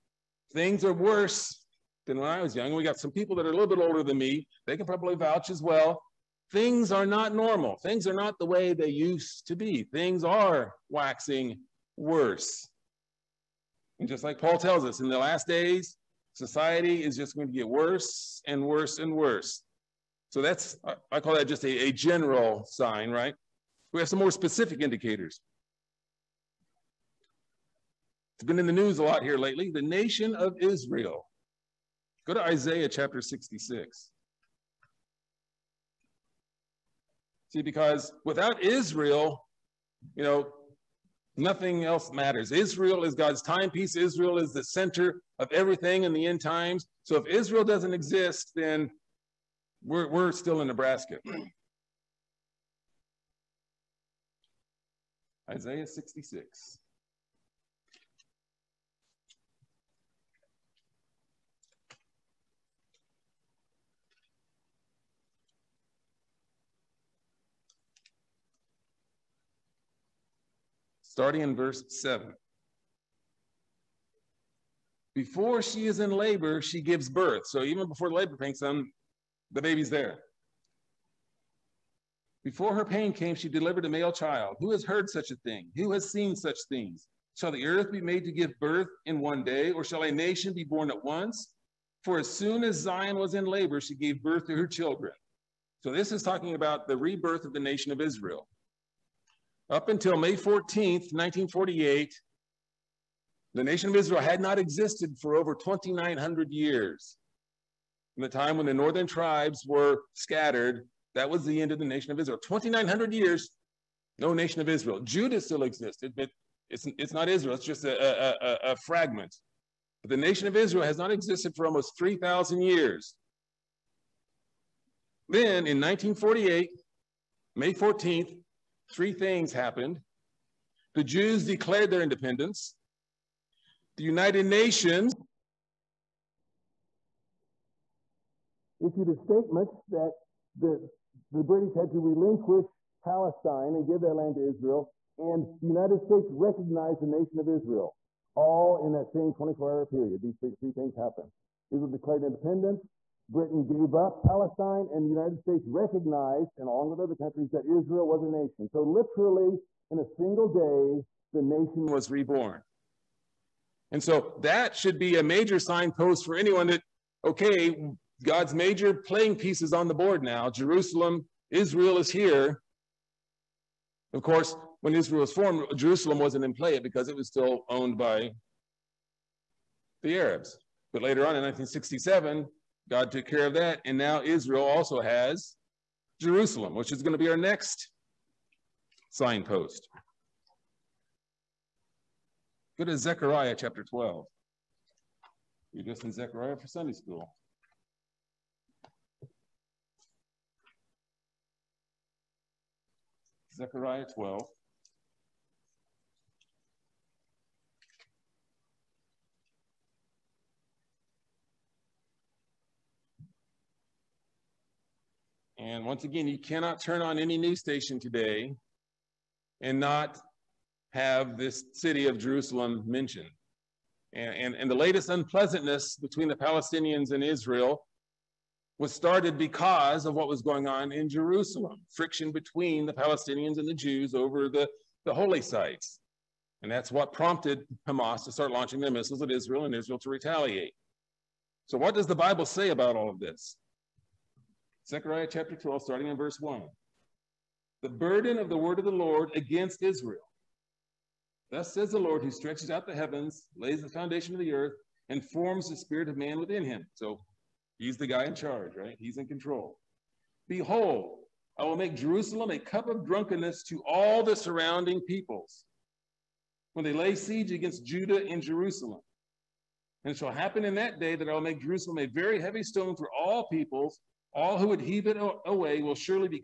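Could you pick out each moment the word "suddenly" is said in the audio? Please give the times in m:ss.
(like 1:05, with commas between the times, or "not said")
not said.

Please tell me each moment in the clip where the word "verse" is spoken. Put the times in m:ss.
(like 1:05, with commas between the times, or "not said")
1:11, 4:06.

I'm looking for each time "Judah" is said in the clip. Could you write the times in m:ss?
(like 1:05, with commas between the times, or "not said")
1:54, 4:27.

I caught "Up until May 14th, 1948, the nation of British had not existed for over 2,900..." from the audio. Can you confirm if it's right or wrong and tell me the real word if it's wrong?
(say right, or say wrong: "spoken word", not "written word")
wrong: "Israel", not "British".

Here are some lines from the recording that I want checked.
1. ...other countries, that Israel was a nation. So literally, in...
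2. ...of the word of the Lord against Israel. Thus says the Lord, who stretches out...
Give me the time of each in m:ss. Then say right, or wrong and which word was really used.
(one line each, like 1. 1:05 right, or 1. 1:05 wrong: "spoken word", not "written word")
1. 2:36 right
2. 4:08 right.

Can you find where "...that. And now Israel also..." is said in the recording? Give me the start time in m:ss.
3:03.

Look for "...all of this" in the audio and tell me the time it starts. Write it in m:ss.
4:02.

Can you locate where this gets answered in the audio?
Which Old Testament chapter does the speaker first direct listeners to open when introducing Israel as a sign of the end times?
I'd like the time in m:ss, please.
0:32.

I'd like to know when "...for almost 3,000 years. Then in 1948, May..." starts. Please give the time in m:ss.
2:01.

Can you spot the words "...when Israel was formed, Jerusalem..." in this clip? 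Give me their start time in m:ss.
2:54.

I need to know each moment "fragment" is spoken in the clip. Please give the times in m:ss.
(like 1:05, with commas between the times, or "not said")
1:58.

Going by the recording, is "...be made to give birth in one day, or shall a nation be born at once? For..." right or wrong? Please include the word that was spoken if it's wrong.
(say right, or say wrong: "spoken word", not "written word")
right.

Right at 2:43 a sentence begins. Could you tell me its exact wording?
And so that should be a major signpost for anyone that, okay, God's major playing pieces on the board now.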